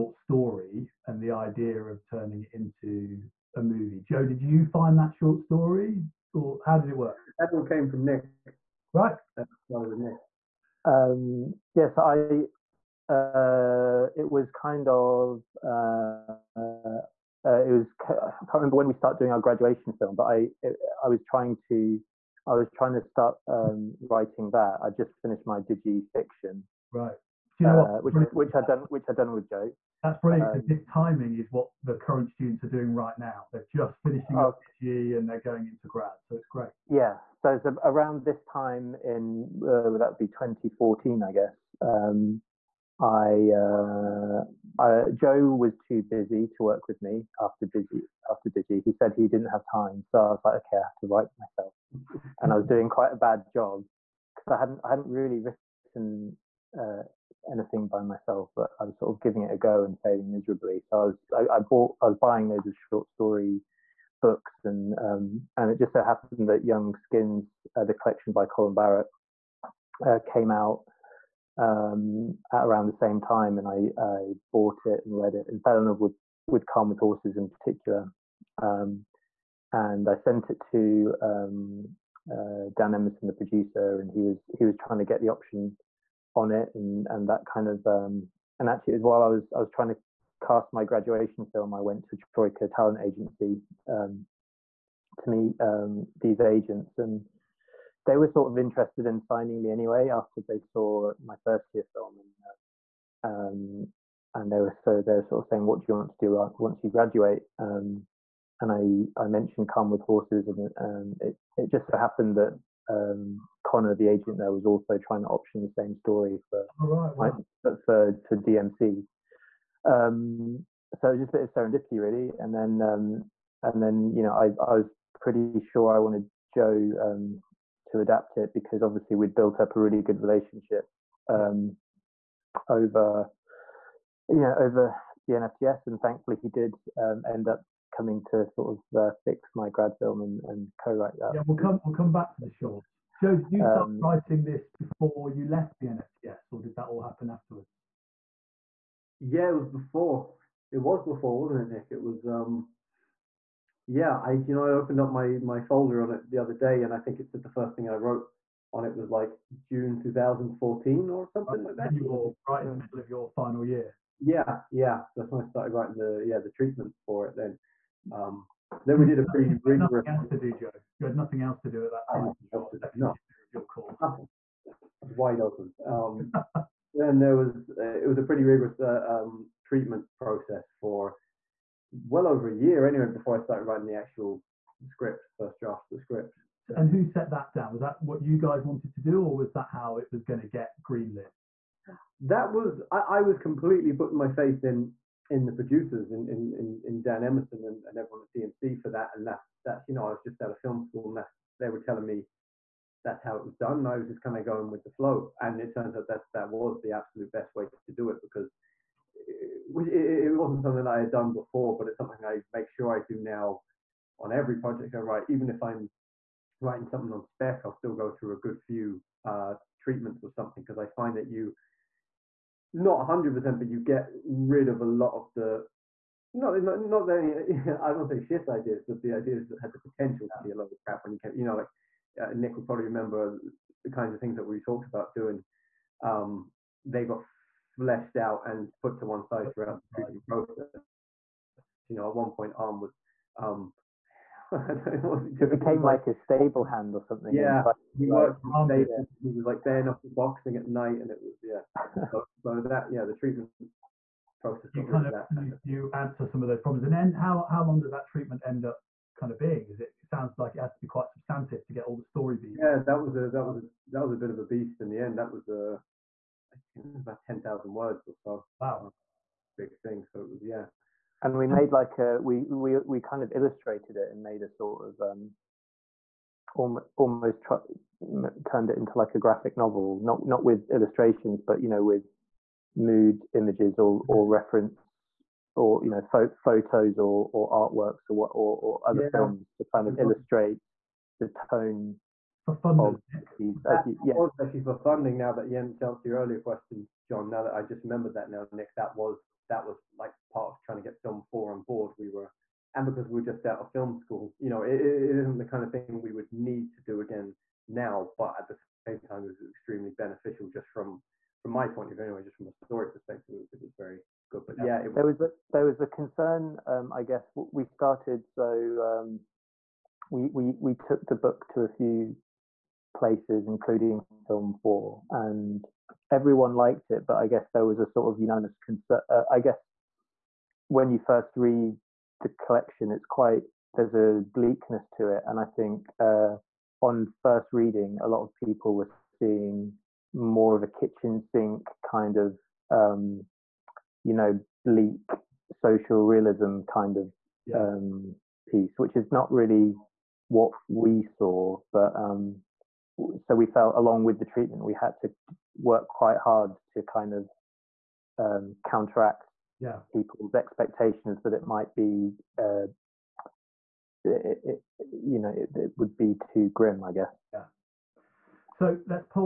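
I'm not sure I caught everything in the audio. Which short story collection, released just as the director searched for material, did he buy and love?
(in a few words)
Young Skins.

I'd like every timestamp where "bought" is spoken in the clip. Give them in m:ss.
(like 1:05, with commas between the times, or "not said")
1:01, 1:14.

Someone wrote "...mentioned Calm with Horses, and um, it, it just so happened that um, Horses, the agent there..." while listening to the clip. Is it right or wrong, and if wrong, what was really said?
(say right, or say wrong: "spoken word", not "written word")
wrong: "Connor", not "Horses".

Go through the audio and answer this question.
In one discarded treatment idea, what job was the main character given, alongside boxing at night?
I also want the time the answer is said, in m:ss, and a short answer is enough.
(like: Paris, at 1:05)
stable hand, at 4:06.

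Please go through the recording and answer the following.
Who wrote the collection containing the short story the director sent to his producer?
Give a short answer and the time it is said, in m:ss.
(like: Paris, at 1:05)
Colin Barrett, at 1:08.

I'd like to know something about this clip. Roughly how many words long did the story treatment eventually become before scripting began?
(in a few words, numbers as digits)
10,000.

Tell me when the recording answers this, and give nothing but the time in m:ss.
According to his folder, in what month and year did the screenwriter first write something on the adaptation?
2:39.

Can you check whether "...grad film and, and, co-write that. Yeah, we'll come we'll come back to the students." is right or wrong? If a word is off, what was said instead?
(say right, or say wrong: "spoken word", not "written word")
wrong: "shorts", not "students".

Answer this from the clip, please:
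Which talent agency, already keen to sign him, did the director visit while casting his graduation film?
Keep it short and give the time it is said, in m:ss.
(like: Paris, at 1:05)
Troika Talent Agency, at 1:32.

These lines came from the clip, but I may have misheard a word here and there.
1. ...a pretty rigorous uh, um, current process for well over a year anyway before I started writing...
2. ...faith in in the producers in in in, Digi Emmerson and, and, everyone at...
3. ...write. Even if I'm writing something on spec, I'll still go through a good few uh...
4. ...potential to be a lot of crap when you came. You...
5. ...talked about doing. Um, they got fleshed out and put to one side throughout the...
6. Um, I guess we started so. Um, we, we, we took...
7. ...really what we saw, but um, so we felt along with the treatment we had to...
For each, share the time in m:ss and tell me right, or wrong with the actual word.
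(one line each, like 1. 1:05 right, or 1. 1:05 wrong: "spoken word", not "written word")
1. 2:58 wrong: "treatment", not "current"
2. 3:14 wrong: "Dan", not "Digi"
3. 3:35 right
4. 3:49 right
5. 3:54 right
6. 5:16 right
7. 5:49 right.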